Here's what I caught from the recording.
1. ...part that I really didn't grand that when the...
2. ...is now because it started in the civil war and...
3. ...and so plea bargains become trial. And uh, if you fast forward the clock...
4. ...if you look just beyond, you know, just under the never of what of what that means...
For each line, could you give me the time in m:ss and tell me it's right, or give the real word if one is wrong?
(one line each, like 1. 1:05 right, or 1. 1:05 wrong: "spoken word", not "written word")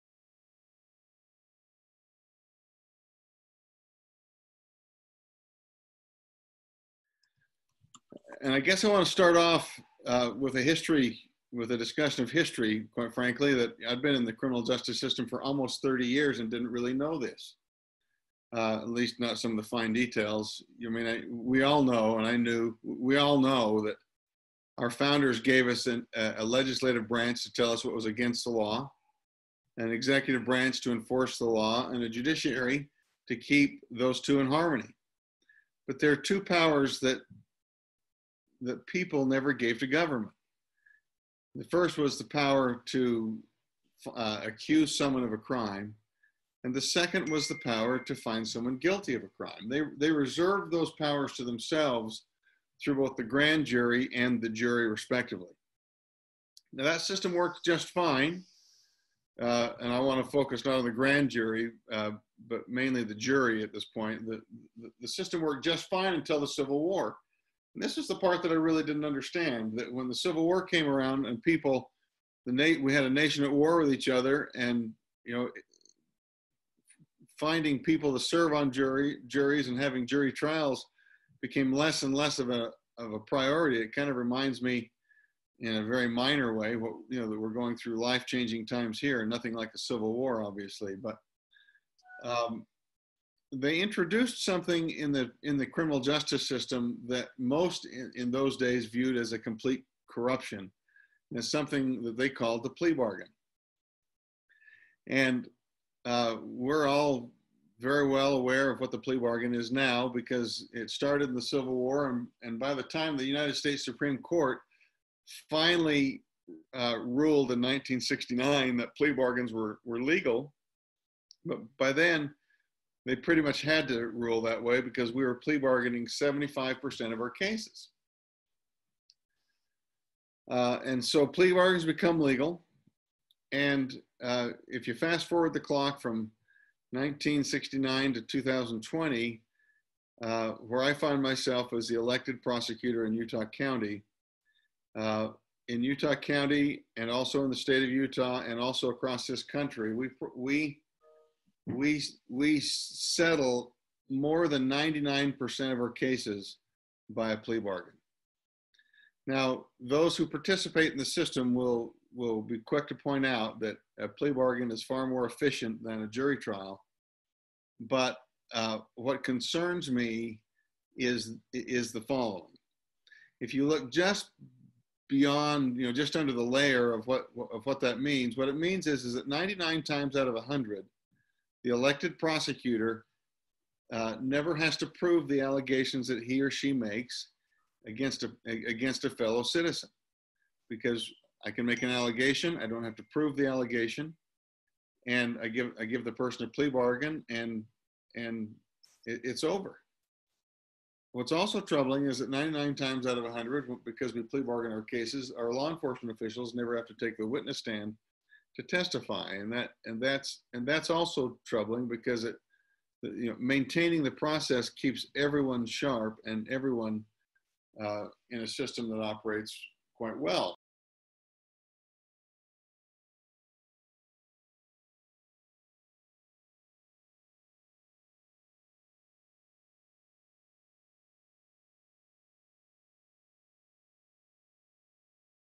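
1. 1:08 wrong: "understand", not "grand"
2. 1:49 right
3. 2:10 wrong: "legal", not "trial"
4. 2:53 wrong: "layer", not "never".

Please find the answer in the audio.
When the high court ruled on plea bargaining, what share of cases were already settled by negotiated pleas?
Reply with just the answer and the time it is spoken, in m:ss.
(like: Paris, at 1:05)
75%, at 2:06.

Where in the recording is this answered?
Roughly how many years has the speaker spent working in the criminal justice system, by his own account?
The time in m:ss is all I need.
0:15.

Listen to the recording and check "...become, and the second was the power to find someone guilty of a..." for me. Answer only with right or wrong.
wrong.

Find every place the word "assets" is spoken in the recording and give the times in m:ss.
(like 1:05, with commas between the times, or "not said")
not said.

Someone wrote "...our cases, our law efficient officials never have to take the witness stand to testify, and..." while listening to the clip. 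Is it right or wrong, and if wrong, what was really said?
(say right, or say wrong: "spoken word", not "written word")
wrong: "enforcement", not "efficient".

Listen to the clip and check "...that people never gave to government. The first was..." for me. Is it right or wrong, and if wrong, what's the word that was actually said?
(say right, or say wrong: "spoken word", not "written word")
right.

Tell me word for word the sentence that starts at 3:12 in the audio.
I don't have to prove the allegation.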